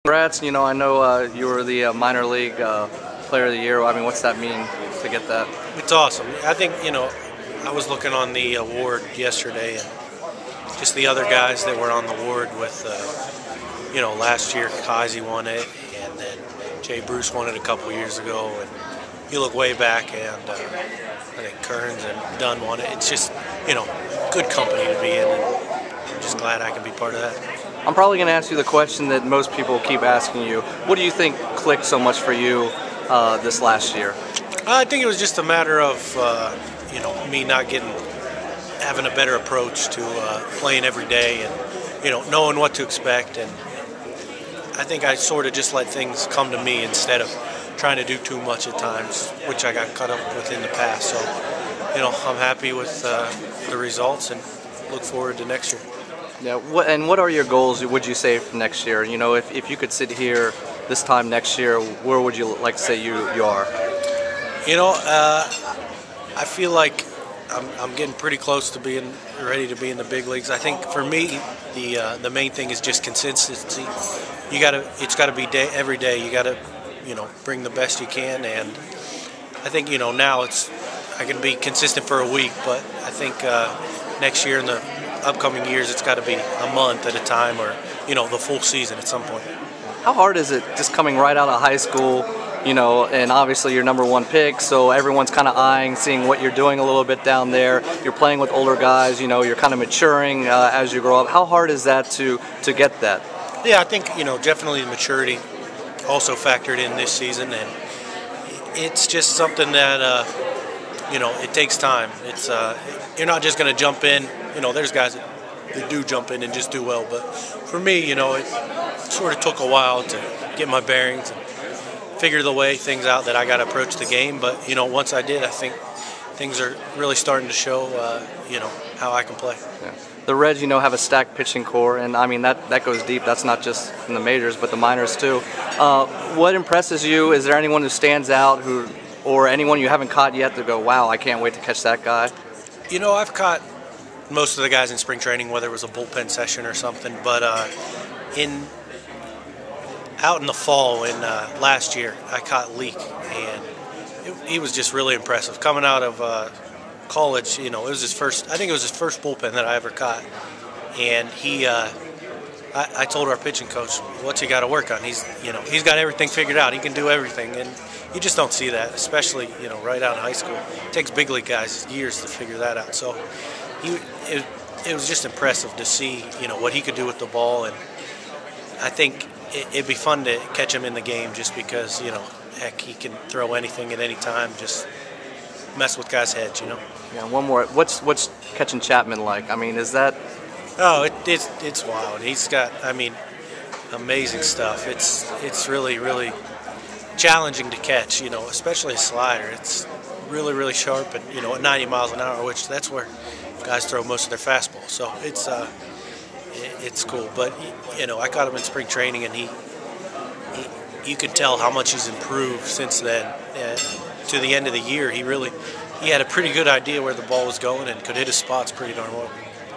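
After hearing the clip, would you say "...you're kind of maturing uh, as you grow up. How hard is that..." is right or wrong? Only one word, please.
right.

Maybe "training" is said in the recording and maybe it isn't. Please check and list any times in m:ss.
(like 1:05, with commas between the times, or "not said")
2:25, 3:28.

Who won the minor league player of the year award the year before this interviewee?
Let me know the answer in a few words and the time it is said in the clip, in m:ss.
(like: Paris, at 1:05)
Heisey, at 0:14.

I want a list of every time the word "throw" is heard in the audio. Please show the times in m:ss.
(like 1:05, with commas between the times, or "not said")
3:03, 3:23.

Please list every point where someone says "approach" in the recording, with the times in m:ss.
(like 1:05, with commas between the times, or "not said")
0:39, 2:03.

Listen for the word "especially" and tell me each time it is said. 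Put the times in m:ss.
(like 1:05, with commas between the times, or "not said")
2:48, 3:18.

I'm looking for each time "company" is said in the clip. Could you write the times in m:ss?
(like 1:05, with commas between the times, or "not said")
0:24.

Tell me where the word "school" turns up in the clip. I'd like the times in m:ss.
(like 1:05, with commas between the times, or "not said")
1:31, 2:50.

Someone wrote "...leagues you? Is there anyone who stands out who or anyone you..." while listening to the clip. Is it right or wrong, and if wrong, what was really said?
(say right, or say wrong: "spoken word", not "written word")
wrong: "impresses", not "leagues".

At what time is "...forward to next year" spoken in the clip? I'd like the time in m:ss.
0:55.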